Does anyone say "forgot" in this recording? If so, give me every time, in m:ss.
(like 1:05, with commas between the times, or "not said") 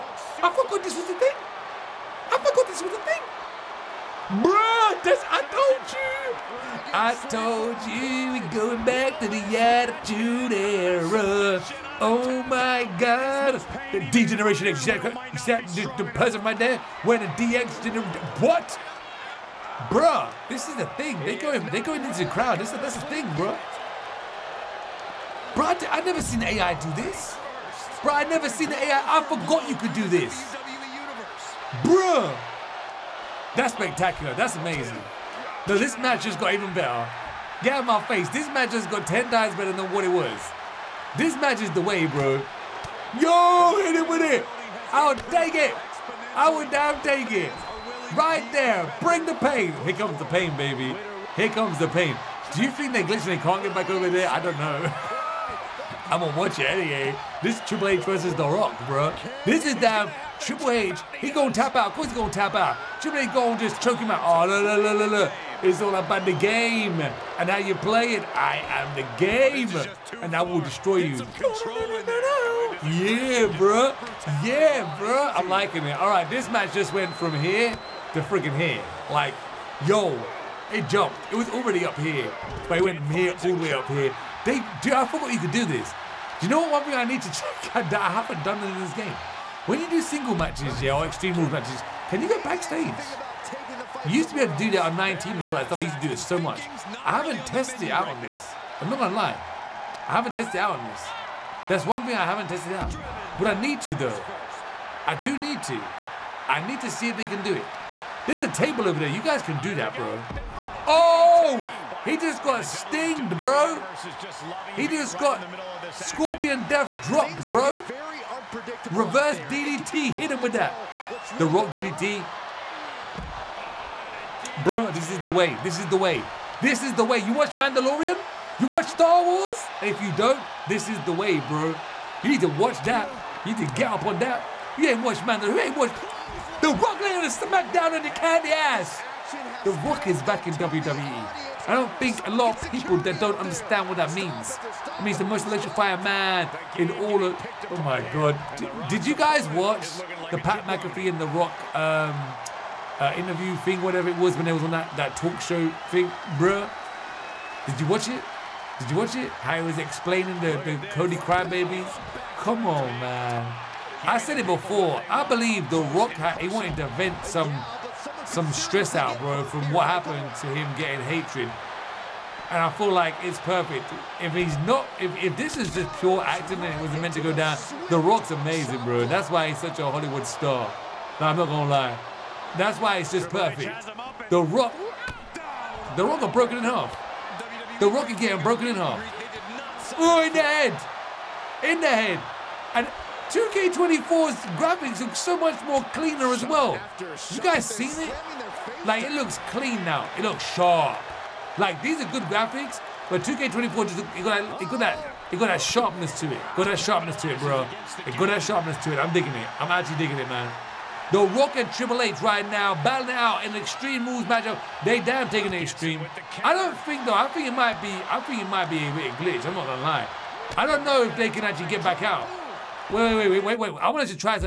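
0:00, 0:29, 1:25.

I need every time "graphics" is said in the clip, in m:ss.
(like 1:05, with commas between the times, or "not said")
3:14, 3:22.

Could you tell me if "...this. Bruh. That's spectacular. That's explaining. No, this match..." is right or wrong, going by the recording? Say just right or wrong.
wrong.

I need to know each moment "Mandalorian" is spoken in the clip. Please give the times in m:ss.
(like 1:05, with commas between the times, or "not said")
2:07, 2:15.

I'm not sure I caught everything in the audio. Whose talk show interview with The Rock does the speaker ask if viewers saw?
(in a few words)
Pat McAfee.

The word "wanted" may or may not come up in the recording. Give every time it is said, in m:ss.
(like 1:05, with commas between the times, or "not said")
2:46, 3:43.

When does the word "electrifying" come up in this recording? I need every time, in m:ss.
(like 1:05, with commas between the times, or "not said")
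2:25.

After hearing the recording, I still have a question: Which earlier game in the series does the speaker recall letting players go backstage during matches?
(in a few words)
19.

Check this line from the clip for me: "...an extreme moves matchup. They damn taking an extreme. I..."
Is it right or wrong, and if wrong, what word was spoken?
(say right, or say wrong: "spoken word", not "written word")
right.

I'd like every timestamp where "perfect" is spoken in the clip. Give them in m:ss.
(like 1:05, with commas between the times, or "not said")
2:53, 3:03.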